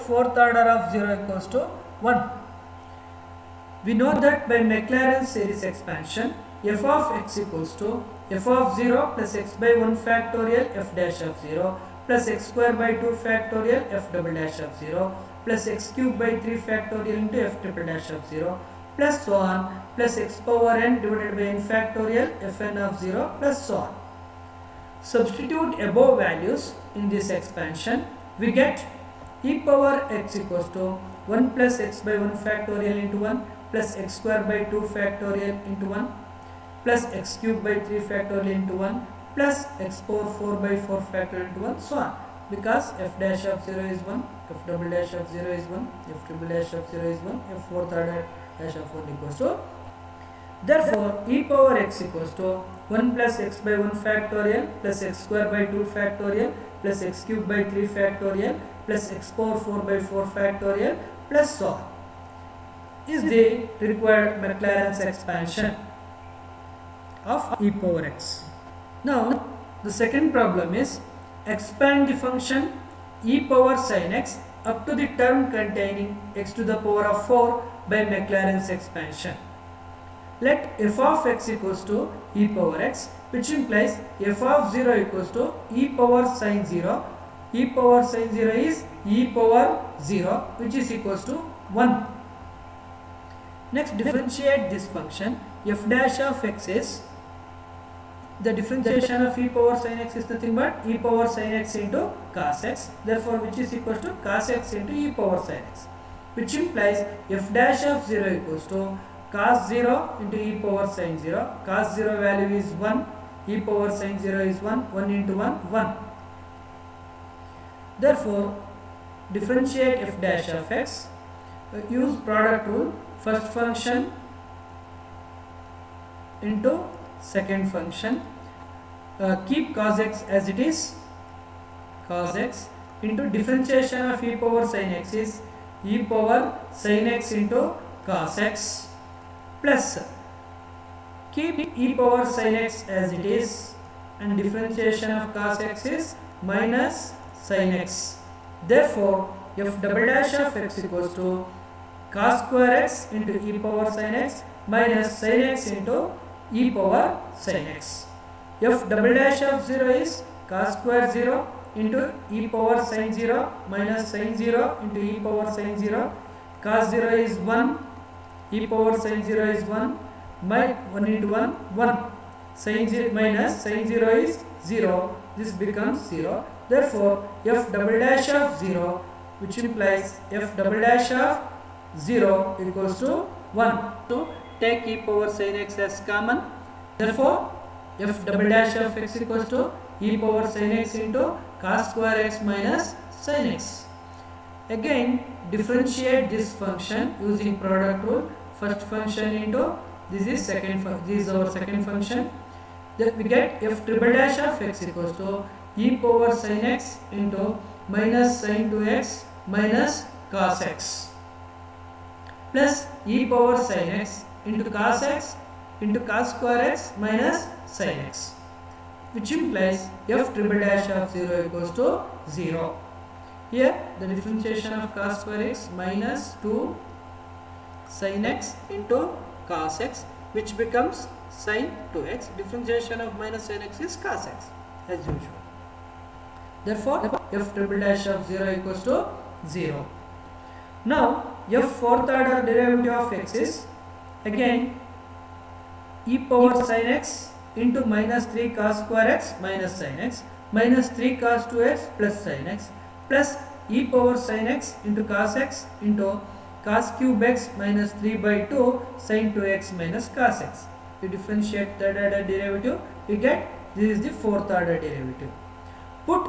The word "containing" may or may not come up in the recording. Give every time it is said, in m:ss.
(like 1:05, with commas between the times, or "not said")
1:15.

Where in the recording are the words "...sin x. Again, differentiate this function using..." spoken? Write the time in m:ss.
3:13.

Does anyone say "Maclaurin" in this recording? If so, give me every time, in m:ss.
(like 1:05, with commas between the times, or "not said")
0:04, 1:04, 1:18.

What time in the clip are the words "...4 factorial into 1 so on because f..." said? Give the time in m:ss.
0:40.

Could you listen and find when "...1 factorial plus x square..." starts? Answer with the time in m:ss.
0:53.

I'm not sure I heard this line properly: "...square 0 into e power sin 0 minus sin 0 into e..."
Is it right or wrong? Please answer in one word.
right.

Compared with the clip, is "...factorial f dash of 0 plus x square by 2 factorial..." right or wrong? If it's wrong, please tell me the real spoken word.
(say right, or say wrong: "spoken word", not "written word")
right.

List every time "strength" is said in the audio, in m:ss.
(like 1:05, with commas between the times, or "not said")
not said.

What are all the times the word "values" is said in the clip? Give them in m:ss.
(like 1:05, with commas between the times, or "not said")
0:26, 1:52.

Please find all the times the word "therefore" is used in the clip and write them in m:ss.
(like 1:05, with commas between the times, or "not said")
0:50, 1:43, 1:57, 2:28, 2:56, 3:06, 3:56.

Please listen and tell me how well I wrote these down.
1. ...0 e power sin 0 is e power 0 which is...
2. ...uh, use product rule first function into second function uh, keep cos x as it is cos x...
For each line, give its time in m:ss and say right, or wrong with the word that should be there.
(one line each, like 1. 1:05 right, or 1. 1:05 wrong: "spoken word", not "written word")
1. 1:26 right
2. 2:01 right.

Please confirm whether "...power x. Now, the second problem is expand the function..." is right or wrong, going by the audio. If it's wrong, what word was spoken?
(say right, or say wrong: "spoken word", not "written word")
right.